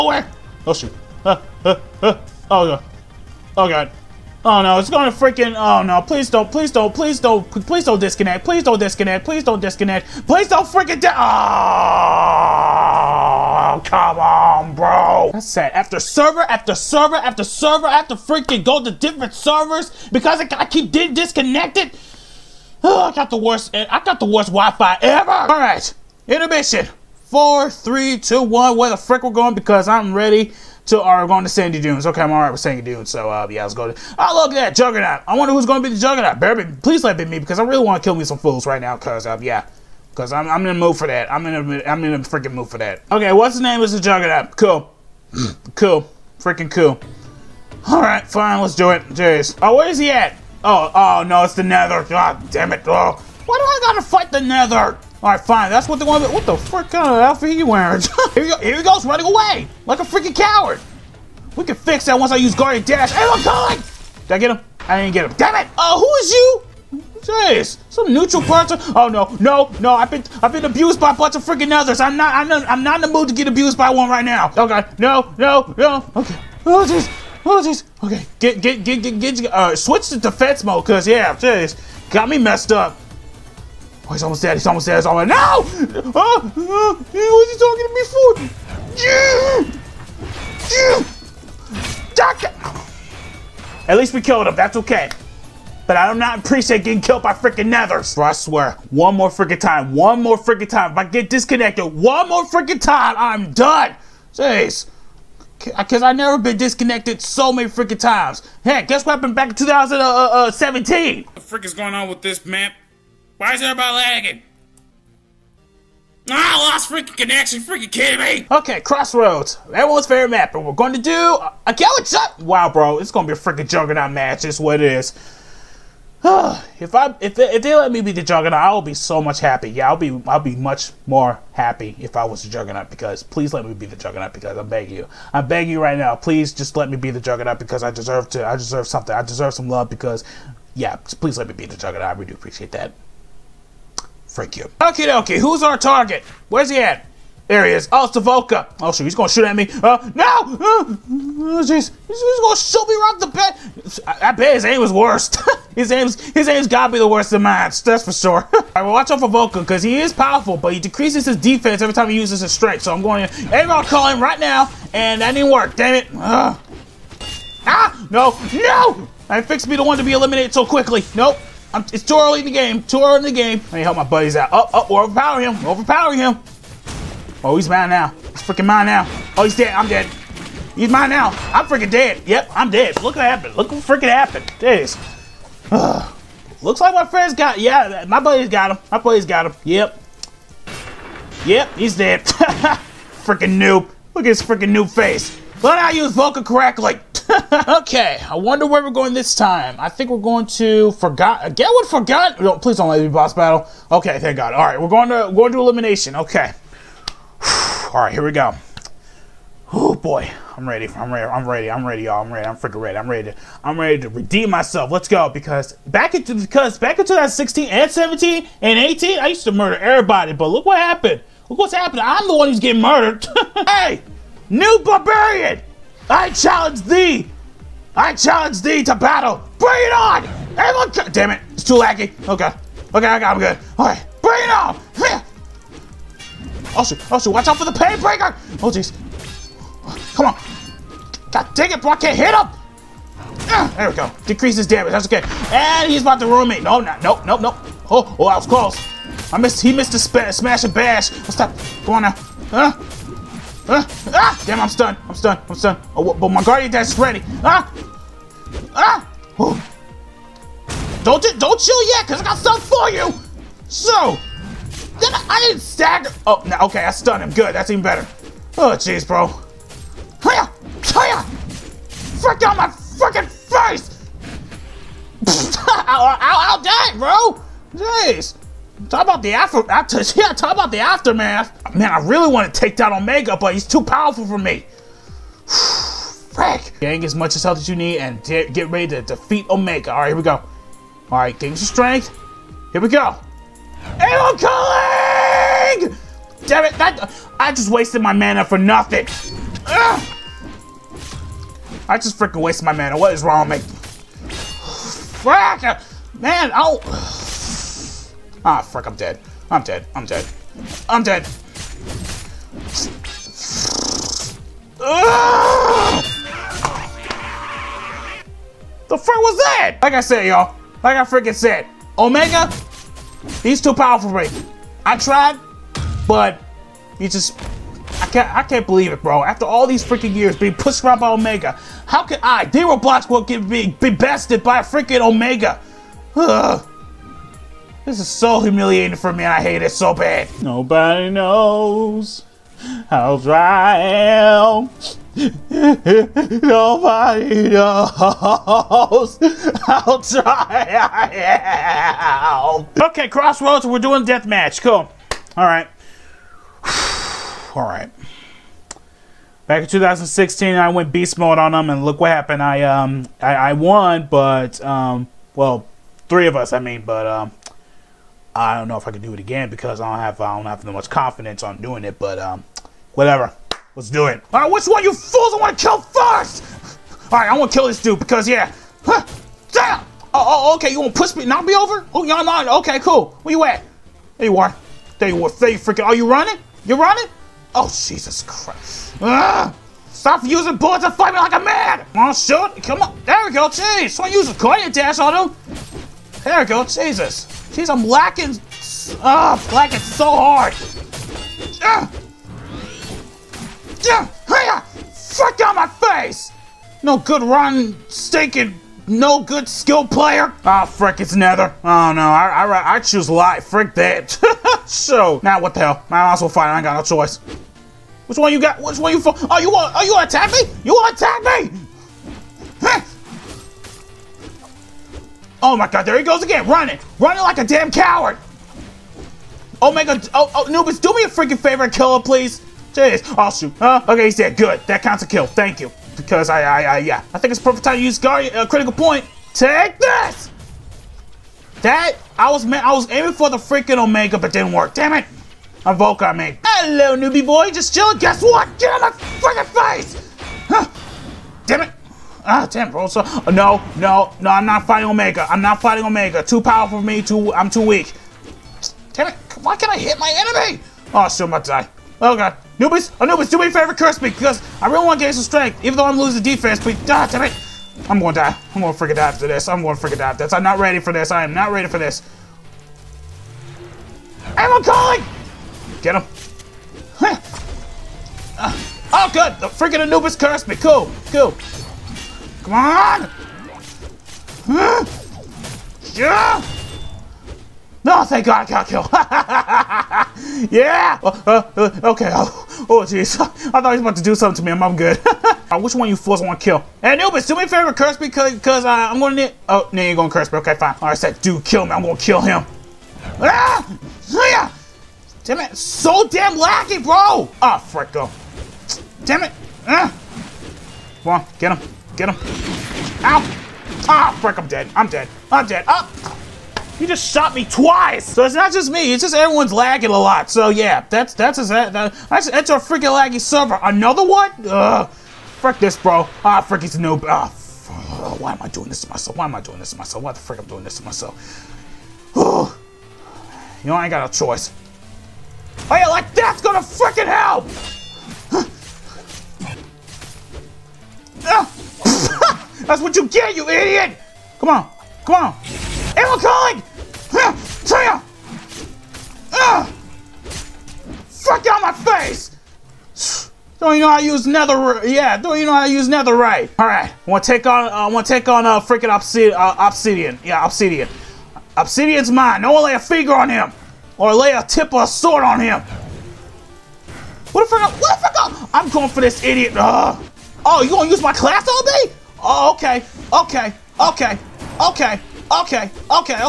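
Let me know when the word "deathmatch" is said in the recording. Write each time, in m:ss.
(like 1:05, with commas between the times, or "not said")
5:54.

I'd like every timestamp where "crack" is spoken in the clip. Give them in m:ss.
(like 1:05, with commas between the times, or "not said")
3:16.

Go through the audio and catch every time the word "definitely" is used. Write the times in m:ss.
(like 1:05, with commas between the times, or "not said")
not said.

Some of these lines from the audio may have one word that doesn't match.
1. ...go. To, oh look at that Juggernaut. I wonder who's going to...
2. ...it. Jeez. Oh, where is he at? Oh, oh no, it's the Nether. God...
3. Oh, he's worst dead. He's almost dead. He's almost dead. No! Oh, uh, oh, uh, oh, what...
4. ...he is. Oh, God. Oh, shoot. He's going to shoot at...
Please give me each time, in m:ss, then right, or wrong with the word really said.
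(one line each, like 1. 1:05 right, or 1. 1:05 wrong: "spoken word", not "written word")
1. 0:33 right
2. 0:48 right
3. 1:24 wrong: "almost", not "worst"
4. 2:27 wrong: "Savoka", not "God".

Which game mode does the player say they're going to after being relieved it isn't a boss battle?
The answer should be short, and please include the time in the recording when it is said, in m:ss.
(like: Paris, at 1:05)
elimination, at 3:25.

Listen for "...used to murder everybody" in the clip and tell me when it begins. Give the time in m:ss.
3:39.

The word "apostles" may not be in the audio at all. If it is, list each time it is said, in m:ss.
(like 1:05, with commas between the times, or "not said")
not said.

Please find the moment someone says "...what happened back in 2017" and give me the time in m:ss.
1:49.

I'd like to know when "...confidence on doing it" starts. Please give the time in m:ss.
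6:10.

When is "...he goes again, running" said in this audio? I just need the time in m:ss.
7:05.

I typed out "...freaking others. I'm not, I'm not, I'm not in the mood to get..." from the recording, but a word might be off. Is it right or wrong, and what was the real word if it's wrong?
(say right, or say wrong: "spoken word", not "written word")
right.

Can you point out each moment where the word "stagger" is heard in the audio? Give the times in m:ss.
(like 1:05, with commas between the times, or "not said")
4:25.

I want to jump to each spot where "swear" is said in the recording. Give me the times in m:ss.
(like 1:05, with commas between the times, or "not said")
1:38.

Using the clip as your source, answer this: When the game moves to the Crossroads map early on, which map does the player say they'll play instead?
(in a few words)
galaxy.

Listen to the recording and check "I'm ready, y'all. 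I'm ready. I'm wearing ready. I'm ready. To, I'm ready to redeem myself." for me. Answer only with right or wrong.
wrong.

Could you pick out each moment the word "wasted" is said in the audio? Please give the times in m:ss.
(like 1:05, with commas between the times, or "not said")
4:57, 5:02.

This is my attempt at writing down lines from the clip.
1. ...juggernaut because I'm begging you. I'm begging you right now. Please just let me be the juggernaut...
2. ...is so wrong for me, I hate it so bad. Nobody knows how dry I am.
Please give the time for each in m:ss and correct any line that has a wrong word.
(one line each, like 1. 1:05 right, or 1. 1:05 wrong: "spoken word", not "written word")
1. 2:13 right
2. 5:38 wrong: "humiliating", not "wrong".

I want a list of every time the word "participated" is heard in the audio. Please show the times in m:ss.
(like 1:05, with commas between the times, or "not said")
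not said.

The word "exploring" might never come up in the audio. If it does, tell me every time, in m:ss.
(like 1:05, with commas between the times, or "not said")
not said.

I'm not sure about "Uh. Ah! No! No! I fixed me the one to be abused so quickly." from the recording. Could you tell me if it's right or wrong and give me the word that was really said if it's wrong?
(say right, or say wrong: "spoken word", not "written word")
wrong: "eliminated", not "abused".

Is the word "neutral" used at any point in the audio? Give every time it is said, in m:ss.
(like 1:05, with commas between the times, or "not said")
1:08.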